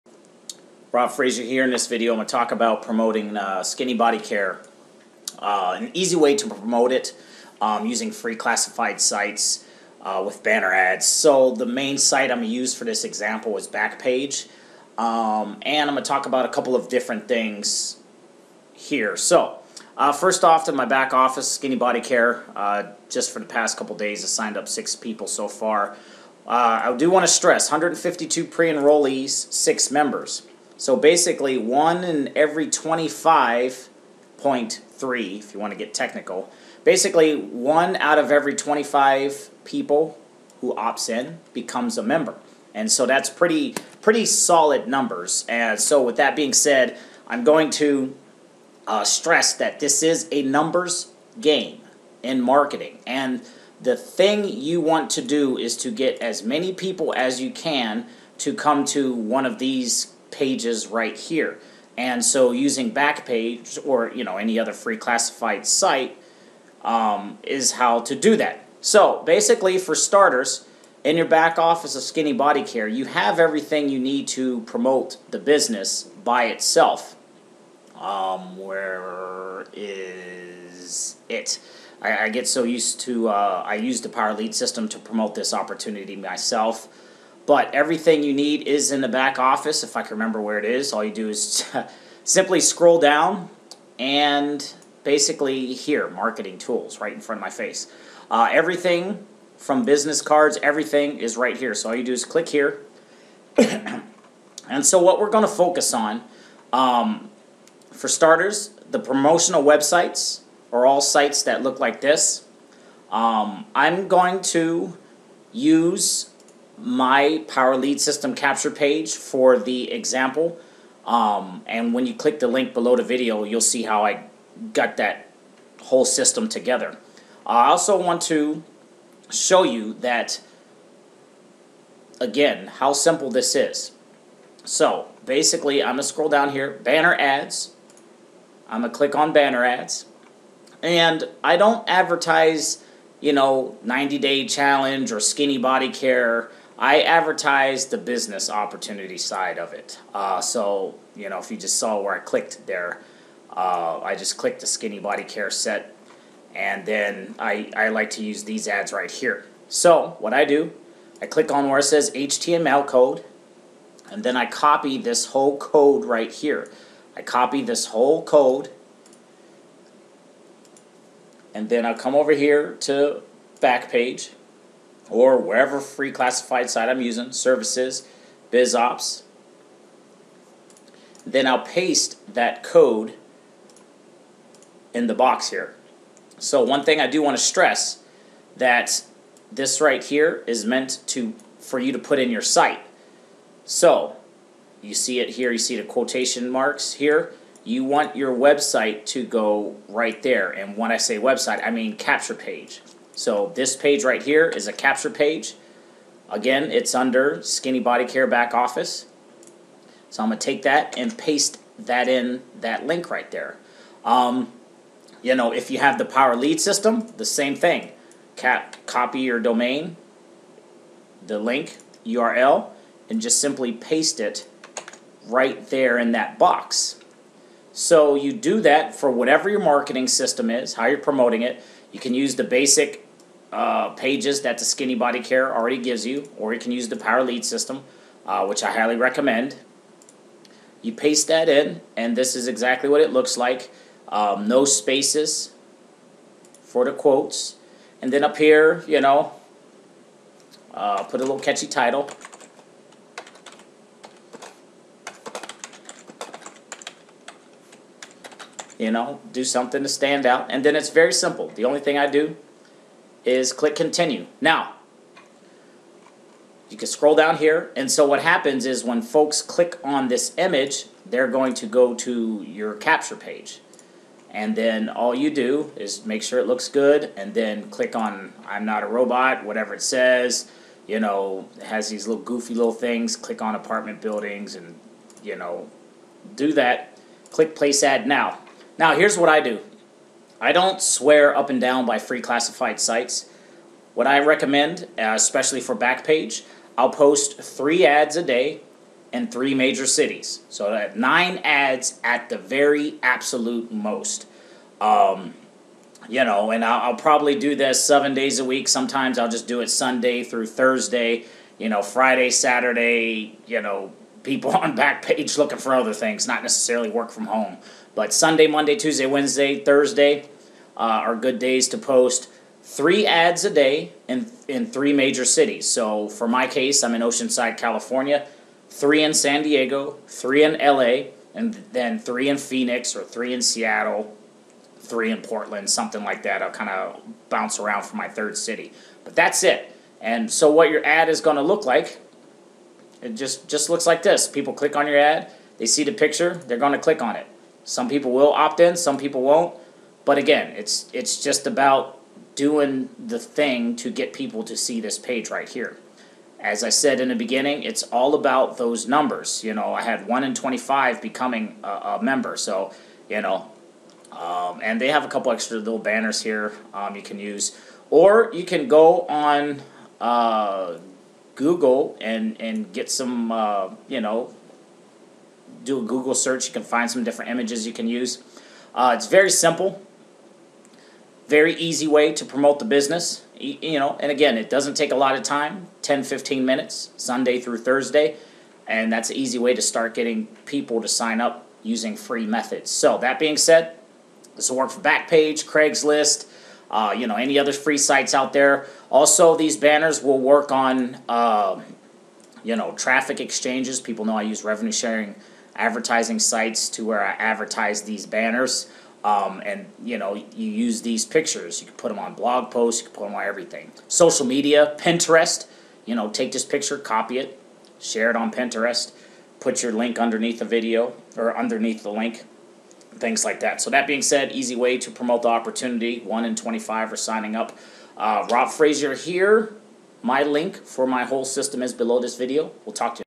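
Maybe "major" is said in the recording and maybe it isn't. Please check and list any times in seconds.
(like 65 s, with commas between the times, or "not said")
299 s, 324 s.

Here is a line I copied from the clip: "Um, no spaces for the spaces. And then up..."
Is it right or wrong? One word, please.
wrong.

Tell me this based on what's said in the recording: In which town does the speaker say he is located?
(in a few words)
Oceanside, California.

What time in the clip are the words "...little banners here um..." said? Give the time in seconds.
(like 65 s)
365 s.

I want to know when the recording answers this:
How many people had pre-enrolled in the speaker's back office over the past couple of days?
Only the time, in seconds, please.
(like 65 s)
27 s.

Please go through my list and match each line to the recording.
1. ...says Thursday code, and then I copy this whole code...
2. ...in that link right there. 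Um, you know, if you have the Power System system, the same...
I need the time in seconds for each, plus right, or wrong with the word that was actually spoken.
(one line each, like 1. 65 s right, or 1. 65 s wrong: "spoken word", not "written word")
1. 161 s wrong: "HTML", not "Thursday"
2. 212 s wrong: "Lead", not "System".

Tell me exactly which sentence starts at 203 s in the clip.
So this page right here is a capture page.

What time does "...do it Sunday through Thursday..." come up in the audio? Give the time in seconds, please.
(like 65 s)
309 s.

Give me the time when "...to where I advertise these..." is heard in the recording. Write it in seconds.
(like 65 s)
406 s.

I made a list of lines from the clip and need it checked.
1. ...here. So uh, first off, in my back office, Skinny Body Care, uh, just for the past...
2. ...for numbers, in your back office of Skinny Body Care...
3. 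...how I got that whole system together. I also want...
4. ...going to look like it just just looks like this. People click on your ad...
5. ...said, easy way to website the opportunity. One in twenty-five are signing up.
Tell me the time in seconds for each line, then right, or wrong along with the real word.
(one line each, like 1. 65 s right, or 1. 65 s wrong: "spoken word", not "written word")
1. 18 s right
2. 69 s wrong: "starters", not "numbers"
3. 123 s right
4. 341 s right
5. 424 s wrong: "promote", not "website".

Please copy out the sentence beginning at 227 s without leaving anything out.
So you do that for whatever your marketing system is, how you're promoting it.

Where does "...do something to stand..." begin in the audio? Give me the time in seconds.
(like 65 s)
259 s.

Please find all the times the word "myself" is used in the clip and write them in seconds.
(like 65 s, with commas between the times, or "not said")
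86 s.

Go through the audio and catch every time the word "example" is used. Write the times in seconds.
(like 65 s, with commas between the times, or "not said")
13 s, 119 s.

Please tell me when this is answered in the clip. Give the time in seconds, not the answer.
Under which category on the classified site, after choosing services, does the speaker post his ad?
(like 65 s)
178 s.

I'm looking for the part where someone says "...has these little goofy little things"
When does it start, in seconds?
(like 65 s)
281 s.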